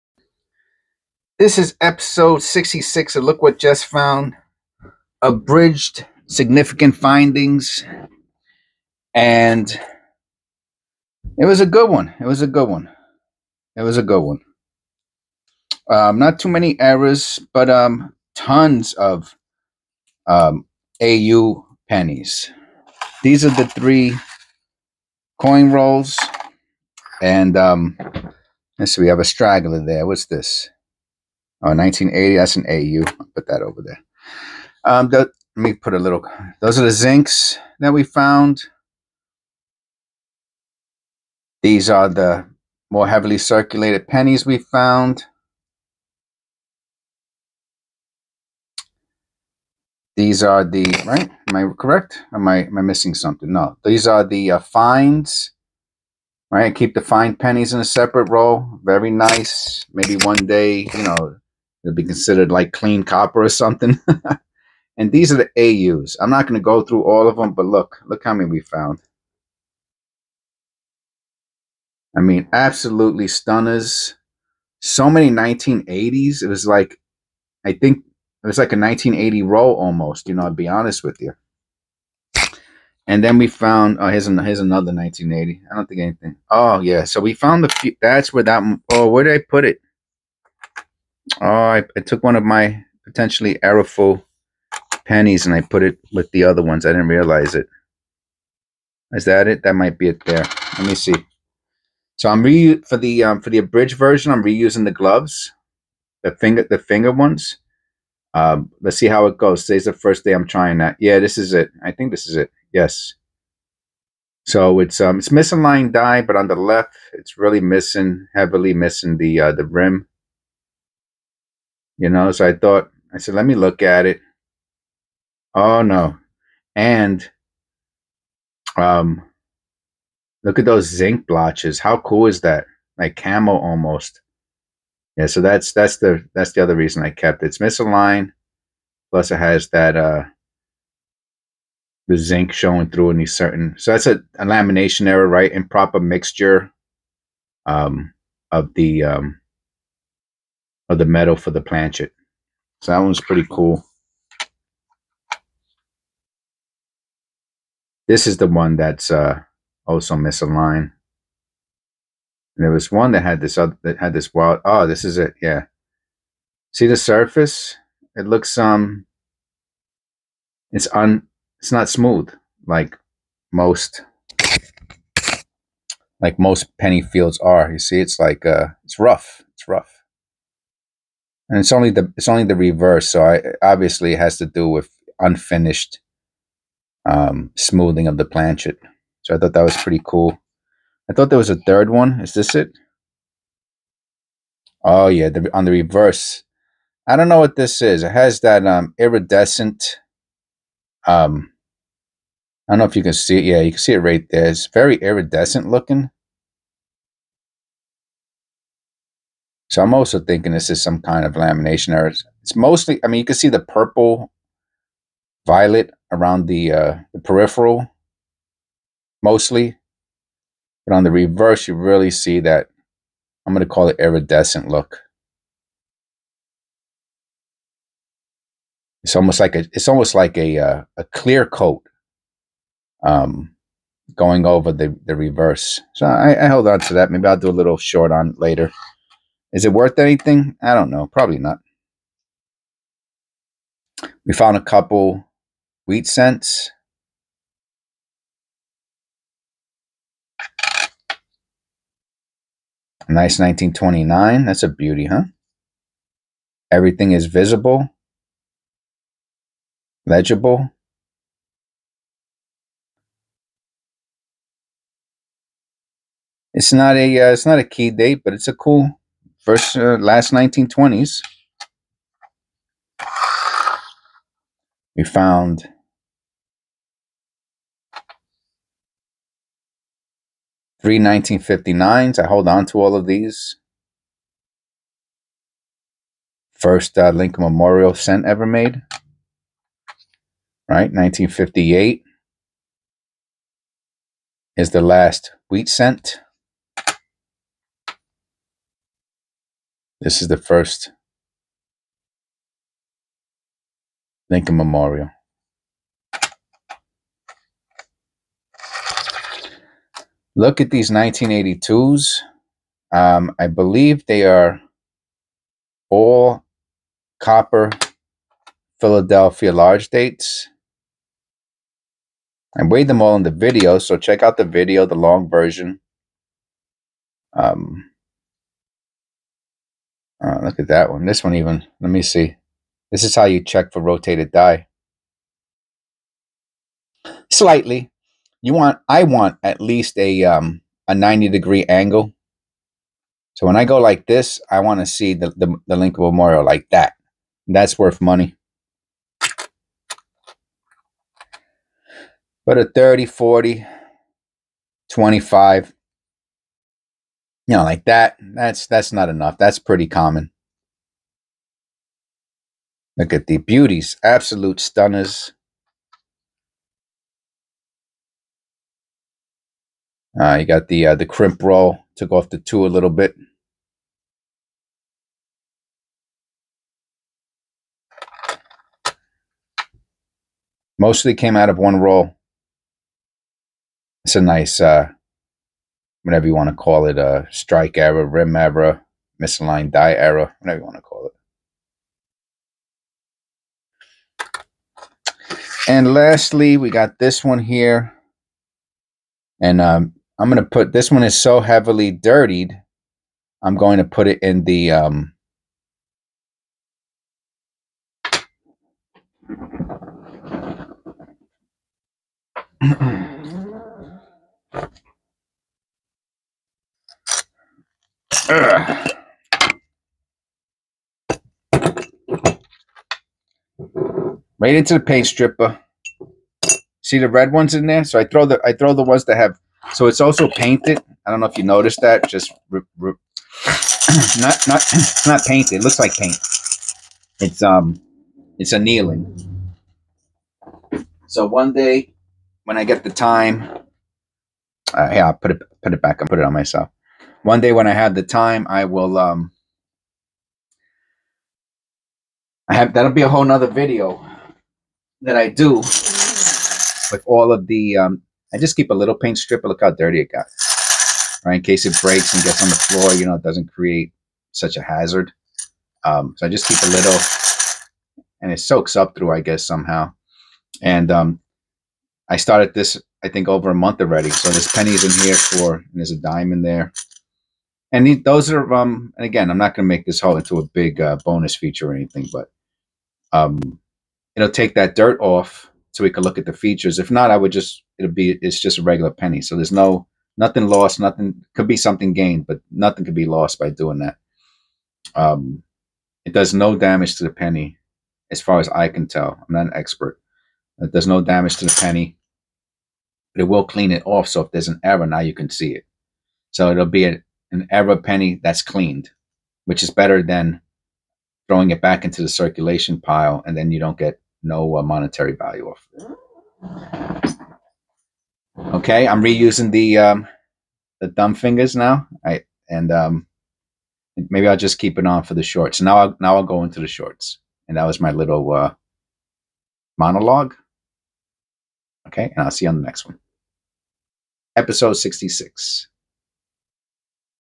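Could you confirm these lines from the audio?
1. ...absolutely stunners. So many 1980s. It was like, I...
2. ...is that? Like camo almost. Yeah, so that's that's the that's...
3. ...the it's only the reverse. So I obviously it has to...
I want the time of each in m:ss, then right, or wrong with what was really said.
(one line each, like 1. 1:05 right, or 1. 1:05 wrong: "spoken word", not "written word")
1. 1:12 right
2. 2:12 right
3. 3:01 right.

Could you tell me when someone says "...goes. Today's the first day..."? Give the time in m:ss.
1:49.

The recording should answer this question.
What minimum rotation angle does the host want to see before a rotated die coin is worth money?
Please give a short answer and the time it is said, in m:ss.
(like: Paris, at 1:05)
90 degree, at 5:40.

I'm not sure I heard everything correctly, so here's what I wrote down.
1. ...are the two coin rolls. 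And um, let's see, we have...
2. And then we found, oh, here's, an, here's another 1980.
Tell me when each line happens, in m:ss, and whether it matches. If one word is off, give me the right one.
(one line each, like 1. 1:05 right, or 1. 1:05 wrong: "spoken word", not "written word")
1. 0:23 wrong: "three", not "two"
2. 1:23 right.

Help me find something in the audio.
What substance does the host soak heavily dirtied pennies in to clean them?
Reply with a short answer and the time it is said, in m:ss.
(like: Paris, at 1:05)
paint stripper, at 7:04.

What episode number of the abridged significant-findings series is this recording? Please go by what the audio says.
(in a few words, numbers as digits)
66.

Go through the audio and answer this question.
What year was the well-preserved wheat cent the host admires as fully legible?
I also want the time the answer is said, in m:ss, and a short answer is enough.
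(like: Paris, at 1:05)
1929, at 4:13.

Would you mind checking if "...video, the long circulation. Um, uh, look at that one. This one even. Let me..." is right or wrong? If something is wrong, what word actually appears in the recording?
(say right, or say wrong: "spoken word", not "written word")
wrong: "version", not "circulation".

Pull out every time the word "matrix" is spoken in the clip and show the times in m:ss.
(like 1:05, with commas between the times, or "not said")
not said.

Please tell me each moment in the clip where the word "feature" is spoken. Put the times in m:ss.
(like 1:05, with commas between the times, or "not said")
8:01, 8:06.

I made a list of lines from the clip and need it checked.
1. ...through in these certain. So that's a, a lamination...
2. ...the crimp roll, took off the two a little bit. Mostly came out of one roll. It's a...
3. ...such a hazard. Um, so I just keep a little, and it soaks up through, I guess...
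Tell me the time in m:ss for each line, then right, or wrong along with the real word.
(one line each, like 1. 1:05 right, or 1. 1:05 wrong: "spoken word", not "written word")
1. 2:22 right
2. 6:10 right
3. 7:44 right.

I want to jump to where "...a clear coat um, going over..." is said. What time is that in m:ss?
3:50.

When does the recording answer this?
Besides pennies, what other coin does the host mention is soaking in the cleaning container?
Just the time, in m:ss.
7:55.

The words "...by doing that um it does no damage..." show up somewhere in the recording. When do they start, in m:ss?
8:13.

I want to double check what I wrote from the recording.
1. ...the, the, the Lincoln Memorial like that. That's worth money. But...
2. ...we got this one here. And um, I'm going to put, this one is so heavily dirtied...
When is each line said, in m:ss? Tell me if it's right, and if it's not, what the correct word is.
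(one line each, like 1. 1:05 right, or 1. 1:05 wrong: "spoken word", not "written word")
1. 5:45 right
2. 6:36 right.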